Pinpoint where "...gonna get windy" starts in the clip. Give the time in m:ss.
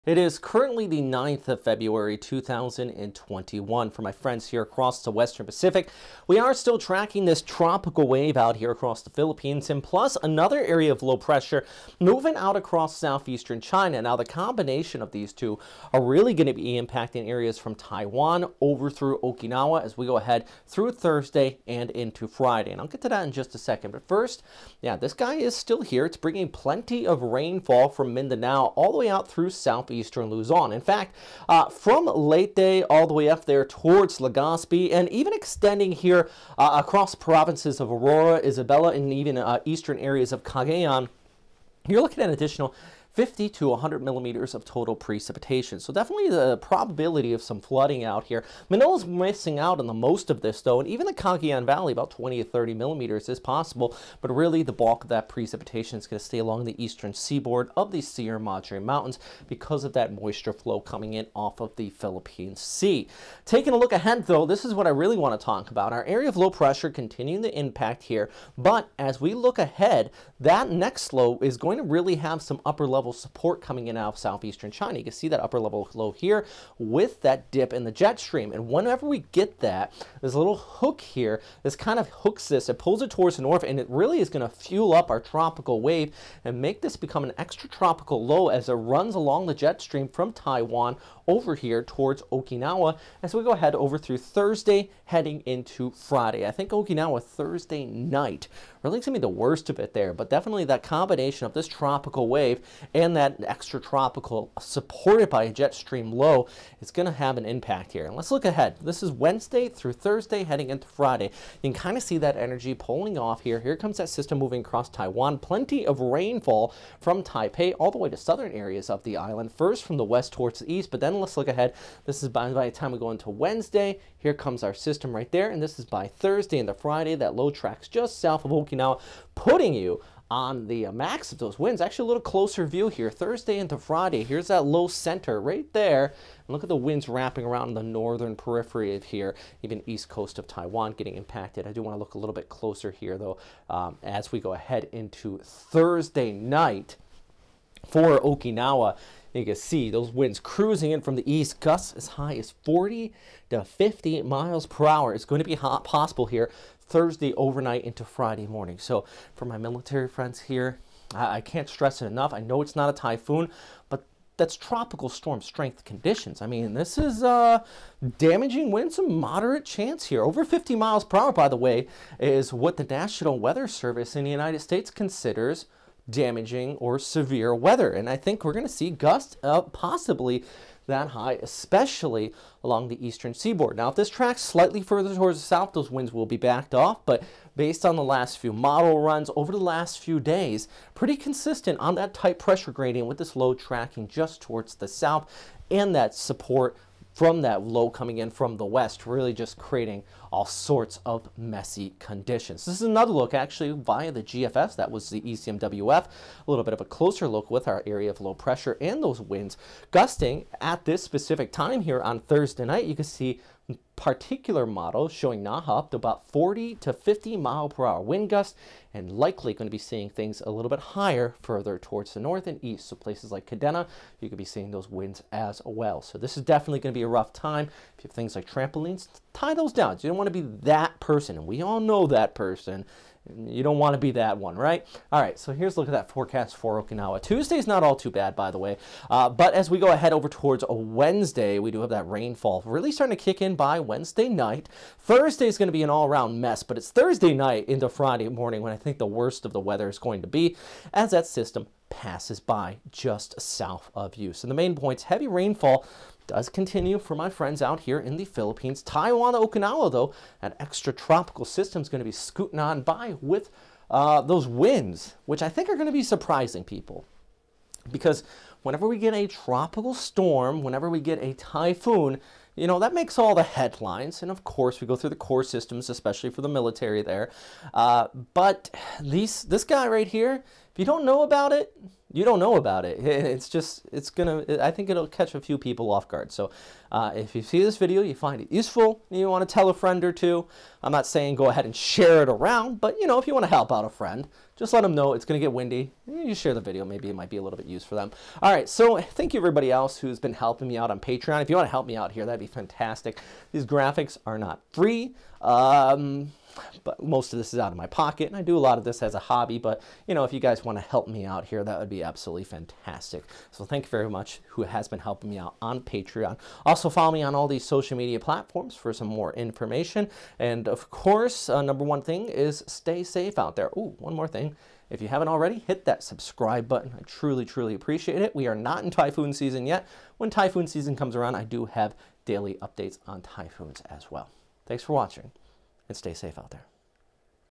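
4:55.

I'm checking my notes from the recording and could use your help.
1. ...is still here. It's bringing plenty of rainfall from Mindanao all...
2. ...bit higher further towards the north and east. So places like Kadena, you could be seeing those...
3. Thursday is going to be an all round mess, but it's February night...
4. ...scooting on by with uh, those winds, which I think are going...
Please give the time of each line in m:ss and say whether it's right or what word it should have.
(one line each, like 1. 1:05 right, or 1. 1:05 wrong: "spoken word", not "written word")
1. 0:25 right
2. 3:40 right
3. 4:04 wrong: "Thursday", not "February"
4. 4:22 right.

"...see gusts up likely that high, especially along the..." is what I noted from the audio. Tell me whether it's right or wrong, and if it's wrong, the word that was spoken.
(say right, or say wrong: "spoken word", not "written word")
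wrong: "possibly", not "likely".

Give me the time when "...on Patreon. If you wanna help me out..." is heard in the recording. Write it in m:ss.
5:00.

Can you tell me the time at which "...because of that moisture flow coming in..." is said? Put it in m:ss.
0:59.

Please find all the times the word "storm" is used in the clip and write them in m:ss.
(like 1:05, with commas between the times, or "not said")
2:45, 4:29.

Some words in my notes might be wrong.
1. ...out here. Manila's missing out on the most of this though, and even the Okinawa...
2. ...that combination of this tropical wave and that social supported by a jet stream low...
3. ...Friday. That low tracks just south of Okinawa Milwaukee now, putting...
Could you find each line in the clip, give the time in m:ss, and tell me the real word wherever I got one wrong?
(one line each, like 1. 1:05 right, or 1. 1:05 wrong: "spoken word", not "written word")
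1. 0:48 wrong: "Cagayan", not "Okinawa"
2. 1:40 wrong: "extratropical", not "social"
3. 2:06 right.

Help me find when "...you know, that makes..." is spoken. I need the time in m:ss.
4:32.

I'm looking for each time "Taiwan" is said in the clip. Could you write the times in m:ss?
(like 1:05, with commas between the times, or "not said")
0:17, 1:30, 1:54, 2:20, 4:18.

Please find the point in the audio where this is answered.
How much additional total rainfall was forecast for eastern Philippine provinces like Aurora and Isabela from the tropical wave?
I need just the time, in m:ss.
0:43.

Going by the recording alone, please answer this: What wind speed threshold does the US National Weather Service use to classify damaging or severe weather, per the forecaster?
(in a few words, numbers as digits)
Over 50 mph.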